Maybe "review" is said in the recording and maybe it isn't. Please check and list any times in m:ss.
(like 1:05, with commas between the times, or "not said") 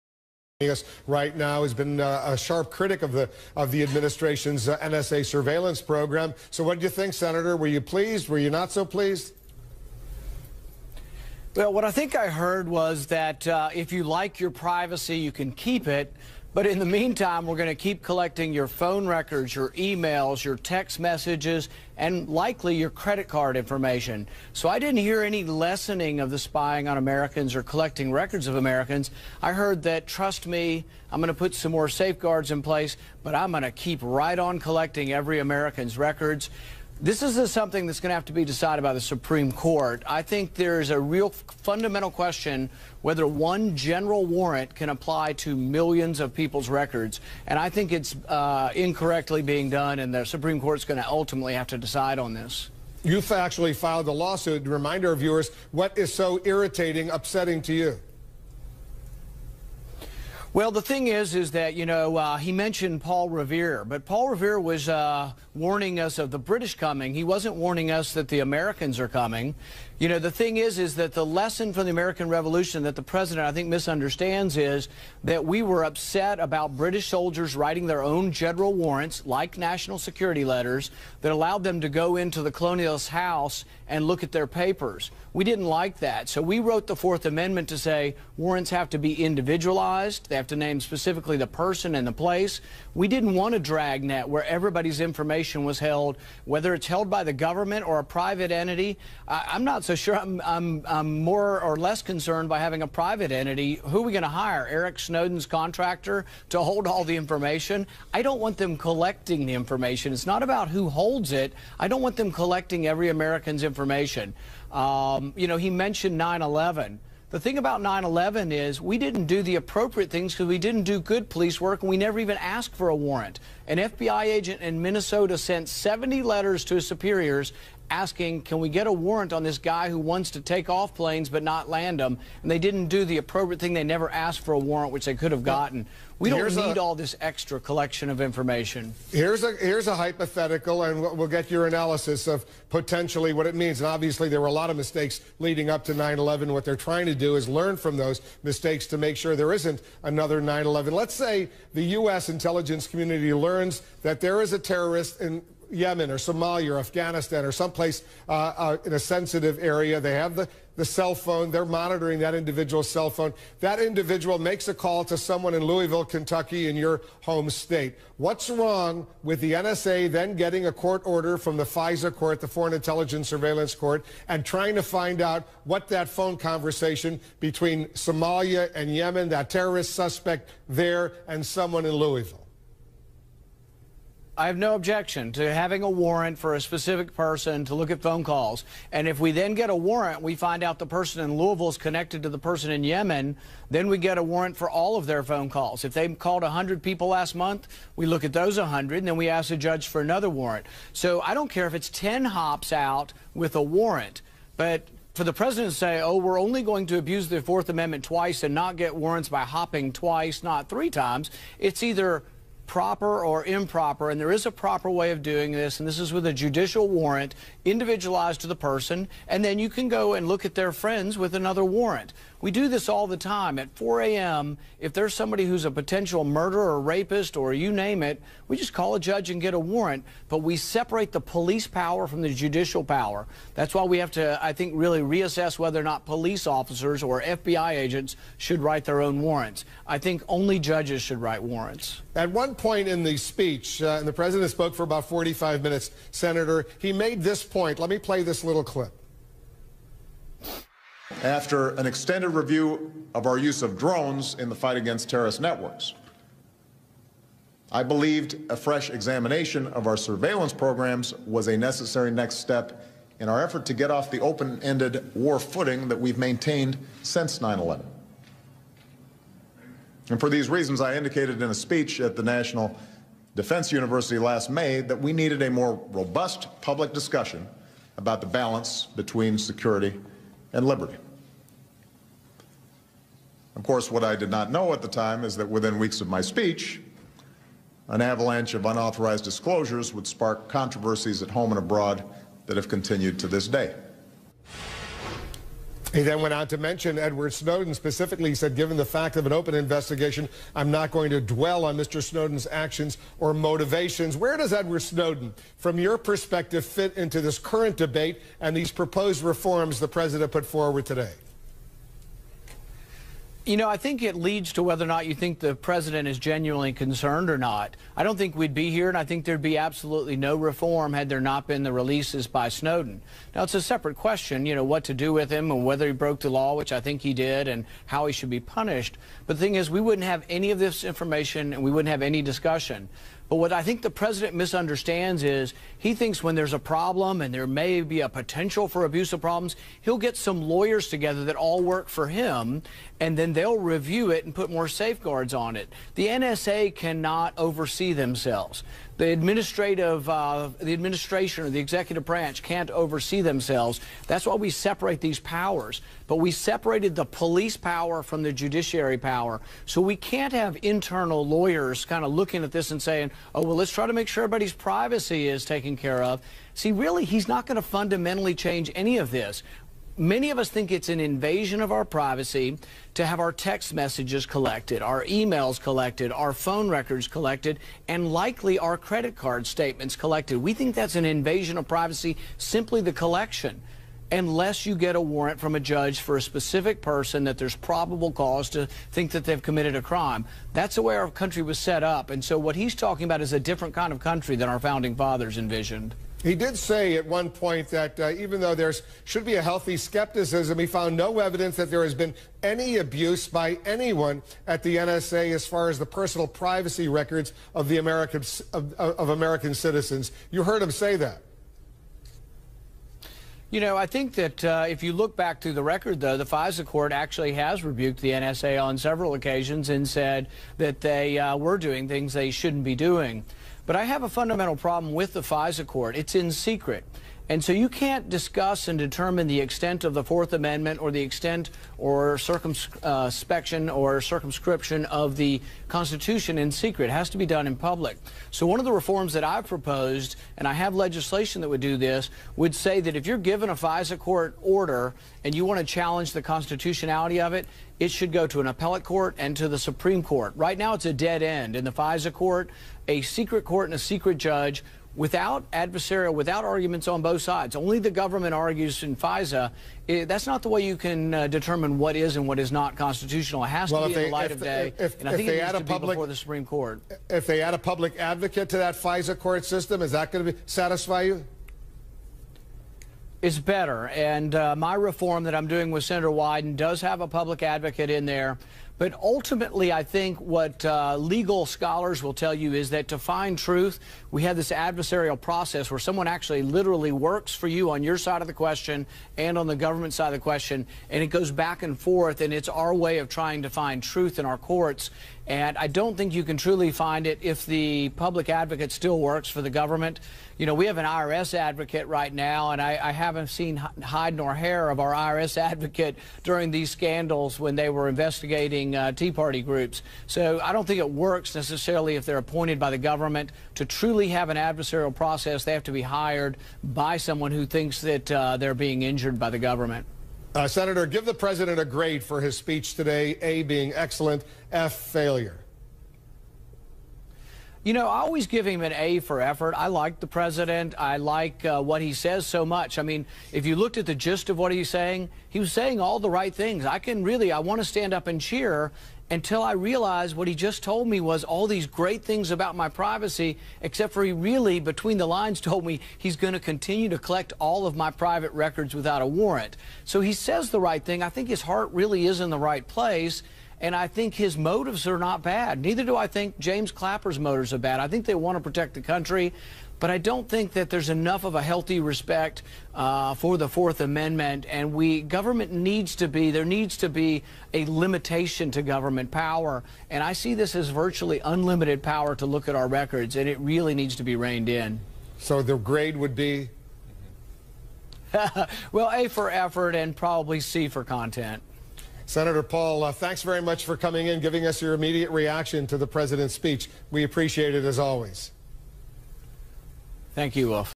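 4:12, 5:43.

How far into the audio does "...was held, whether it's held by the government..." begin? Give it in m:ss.
1:35.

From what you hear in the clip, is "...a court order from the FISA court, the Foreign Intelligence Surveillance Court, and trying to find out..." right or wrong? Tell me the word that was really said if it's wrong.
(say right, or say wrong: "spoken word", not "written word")
right.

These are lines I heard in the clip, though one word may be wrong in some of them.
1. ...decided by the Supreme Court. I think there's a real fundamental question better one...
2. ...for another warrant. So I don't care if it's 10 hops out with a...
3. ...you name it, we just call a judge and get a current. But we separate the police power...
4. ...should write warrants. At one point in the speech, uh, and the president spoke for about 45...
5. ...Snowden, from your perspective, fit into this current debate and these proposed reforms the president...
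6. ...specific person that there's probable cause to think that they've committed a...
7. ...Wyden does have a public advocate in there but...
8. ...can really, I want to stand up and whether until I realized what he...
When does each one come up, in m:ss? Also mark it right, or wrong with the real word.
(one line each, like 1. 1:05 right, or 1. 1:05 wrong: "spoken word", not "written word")
1. 0:38 wrong: "whether", not "better"
2. 3:19 right
3. 3:47 wrong: "warrant", not "current"
4. 4:01 right
5. 5:04 right
6. 6:26 right
7. 7:56 right
8. 8:56 wrong: "cheer", not "whether".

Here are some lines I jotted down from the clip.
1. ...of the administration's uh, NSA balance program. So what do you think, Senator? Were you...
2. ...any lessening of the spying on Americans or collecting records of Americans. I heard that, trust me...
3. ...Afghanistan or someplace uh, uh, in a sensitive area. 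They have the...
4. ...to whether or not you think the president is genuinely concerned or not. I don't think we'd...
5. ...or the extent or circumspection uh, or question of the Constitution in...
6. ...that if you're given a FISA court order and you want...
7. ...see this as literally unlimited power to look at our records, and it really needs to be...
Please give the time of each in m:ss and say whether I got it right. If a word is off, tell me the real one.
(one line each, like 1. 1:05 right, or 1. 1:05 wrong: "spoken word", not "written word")
1. 0:03 wrong: "surveillance", not "balance"
2. 0:25 right
3. 2:36 right
4. 5:14 right
5. 7:10 wrong: "circumscription", not "question"
6. 7:22 right
7. 9:30 wrong: "virtually", not "literally".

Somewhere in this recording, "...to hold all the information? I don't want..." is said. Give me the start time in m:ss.
1:46.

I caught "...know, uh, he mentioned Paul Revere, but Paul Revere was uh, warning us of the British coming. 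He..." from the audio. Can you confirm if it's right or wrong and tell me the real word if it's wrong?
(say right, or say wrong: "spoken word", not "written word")
right.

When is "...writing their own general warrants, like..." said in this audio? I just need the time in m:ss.
1:17.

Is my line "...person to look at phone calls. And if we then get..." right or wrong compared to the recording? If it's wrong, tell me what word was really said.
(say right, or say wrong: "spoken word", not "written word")
right.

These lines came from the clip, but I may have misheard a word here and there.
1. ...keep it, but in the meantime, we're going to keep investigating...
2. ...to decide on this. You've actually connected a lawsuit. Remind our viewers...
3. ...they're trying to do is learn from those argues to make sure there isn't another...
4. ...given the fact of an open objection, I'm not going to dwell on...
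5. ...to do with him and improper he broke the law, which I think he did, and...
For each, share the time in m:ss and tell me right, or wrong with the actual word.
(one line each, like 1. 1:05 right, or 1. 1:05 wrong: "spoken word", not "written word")
1. 0:15 wrong: "collecting", not "investigating"
2. 0:51 wrong: "filed", not "connected"
3. 2:26 wrong: "mistakes", not "argues"
4. 4:58 wrong: "investigation", not "objection"
5. 5:24 wrong: "whether", not "improper".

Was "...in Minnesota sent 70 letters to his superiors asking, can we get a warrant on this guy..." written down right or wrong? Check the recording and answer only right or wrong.
right.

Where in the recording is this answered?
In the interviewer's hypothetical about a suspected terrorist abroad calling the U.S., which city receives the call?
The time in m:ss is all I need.
2:45.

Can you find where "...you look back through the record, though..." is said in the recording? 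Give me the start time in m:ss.
6:54.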